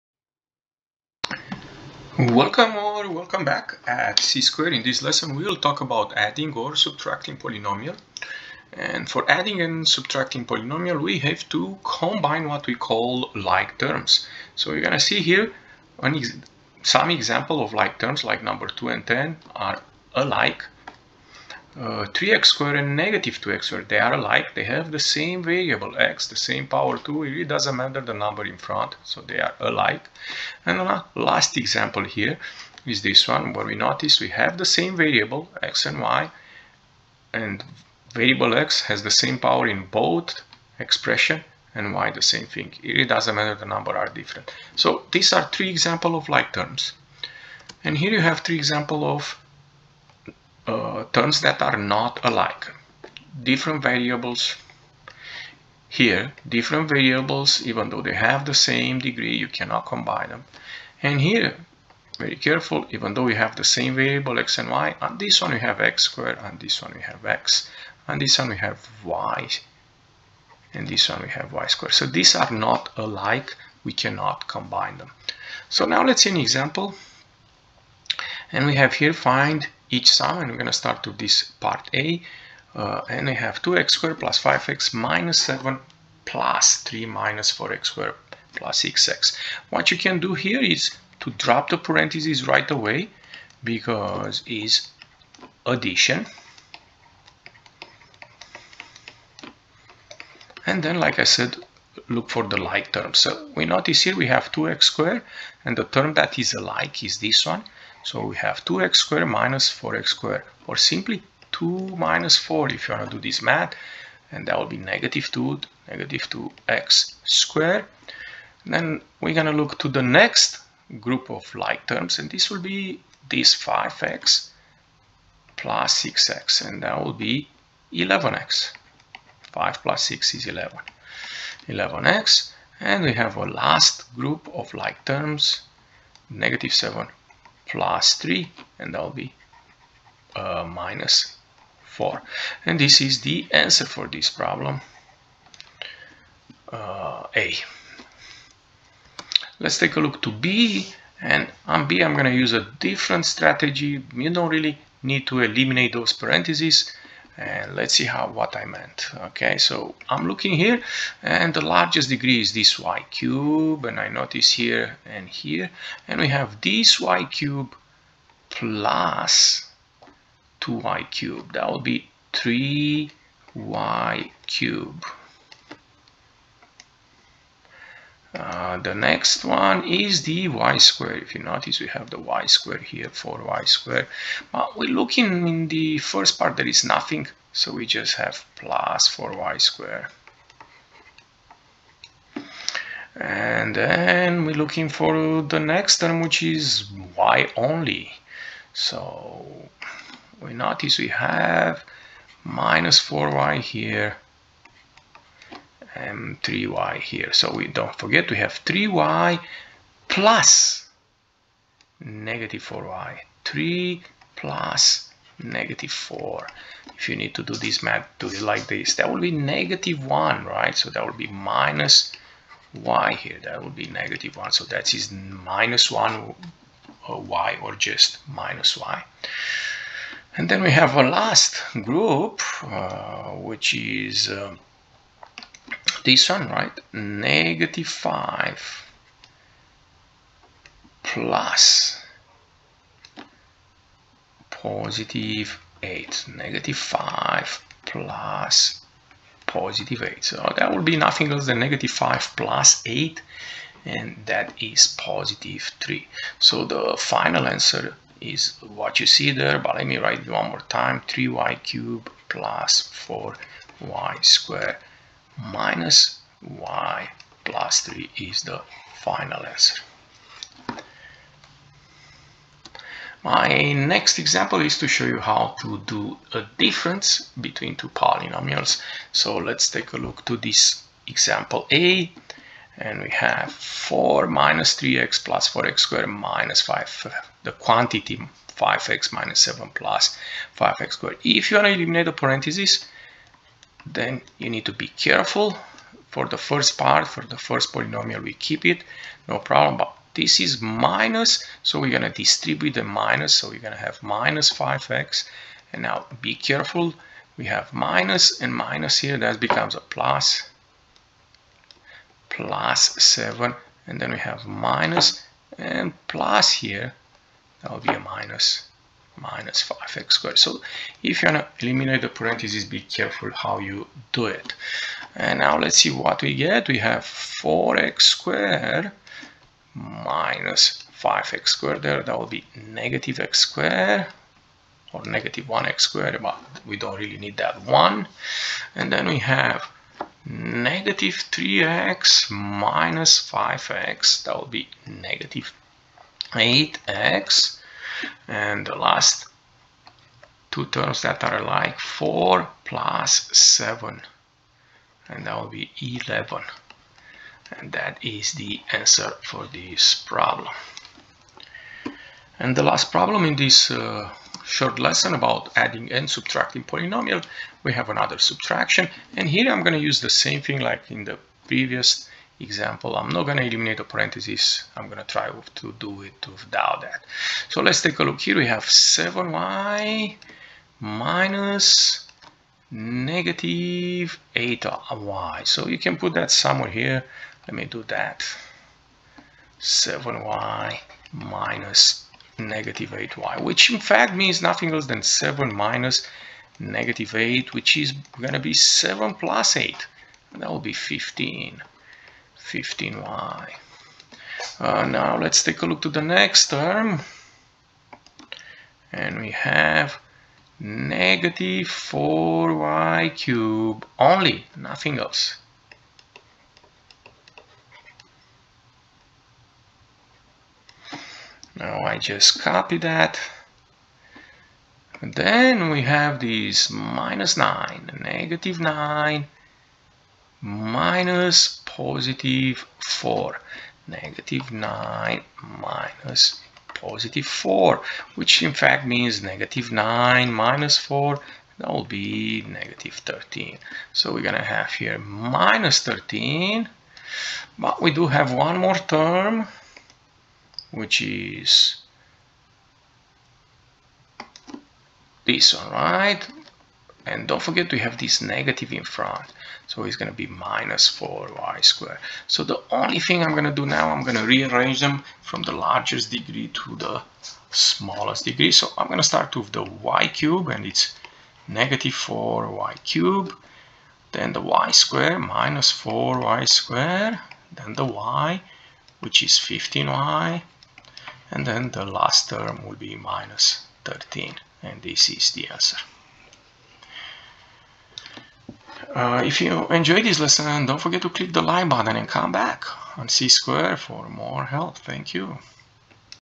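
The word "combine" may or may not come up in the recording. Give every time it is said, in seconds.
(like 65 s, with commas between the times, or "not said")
11 s, 59 s, 74 s.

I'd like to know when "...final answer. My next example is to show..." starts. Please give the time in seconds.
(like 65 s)
268 s.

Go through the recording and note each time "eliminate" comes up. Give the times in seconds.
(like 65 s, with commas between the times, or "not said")
155 s, 291 s, 321 s, 373 s.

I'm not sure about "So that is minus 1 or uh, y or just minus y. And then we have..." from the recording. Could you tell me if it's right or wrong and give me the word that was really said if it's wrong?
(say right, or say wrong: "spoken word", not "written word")
right.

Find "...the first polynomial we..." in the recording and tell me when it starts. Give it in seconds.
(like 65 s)
297 s.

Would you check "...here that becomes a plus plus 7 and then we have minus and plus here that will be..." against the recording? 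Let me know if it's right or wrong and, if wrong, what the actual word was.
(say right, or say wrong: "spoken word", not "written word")
right.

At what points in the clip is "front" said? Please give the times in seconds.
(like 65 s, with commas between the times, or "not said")
28 s, 458 s.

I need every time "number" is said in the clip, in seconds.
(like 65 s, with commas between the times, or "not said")
18 s, 28 s, 43 s.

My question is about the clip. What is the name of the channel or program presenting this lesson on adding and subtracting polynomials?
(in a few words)
C Square.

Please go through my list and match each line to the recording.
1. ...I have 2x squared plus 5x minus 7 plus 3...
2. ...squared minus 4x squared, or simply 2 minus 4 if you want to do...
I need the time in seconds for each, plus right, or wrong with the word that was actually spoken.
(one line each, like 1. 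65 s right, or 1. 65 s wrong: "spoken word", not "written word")
1. 83 s right
2. 108 s right.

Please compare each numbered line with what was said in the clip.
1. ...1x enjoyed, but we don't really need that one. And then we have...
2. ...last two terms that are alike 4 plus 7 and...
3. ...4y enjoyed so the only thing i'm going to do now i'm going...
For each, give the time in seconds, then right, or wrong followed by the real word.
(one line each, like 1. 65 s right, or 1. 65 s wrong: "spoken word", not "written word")
1. 335 s wrong: "squared", not "enjoyed"
2. 348 s right
3. 460 s wrong: "squared", not "enjoyed".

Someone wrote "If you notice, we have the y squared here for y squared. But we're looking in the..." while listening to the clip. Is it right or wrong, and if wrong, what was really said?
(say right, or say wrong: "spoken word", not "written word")
right.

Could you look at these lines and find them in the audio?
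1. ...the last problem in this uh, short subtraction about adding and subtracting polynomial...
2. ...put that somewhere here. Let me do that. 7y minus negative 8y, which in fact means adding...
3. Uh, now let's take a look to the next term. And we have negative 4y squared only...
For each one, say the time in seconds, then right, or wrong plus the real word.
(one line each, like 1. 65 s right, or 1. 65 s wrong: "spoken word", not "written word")
1. 362 s wrong: "lesson", not "subtraction"
2. 385 s wrong: "nothing", not "adding"
3. 404 s wrong: "cubed", not "squared".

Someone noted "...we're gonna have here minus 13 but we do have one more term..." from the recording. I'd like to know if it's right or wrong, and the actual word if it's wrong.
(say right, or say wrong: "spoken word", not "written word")
right.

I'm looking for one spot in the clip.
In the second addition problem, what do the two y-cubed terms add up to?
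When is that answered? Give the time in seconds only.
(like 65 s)
172 s.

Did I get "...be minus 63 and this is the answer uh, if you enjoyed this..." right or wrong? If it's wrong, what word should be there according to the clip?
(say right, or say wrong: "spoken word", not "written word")
wrong: "13", not "63".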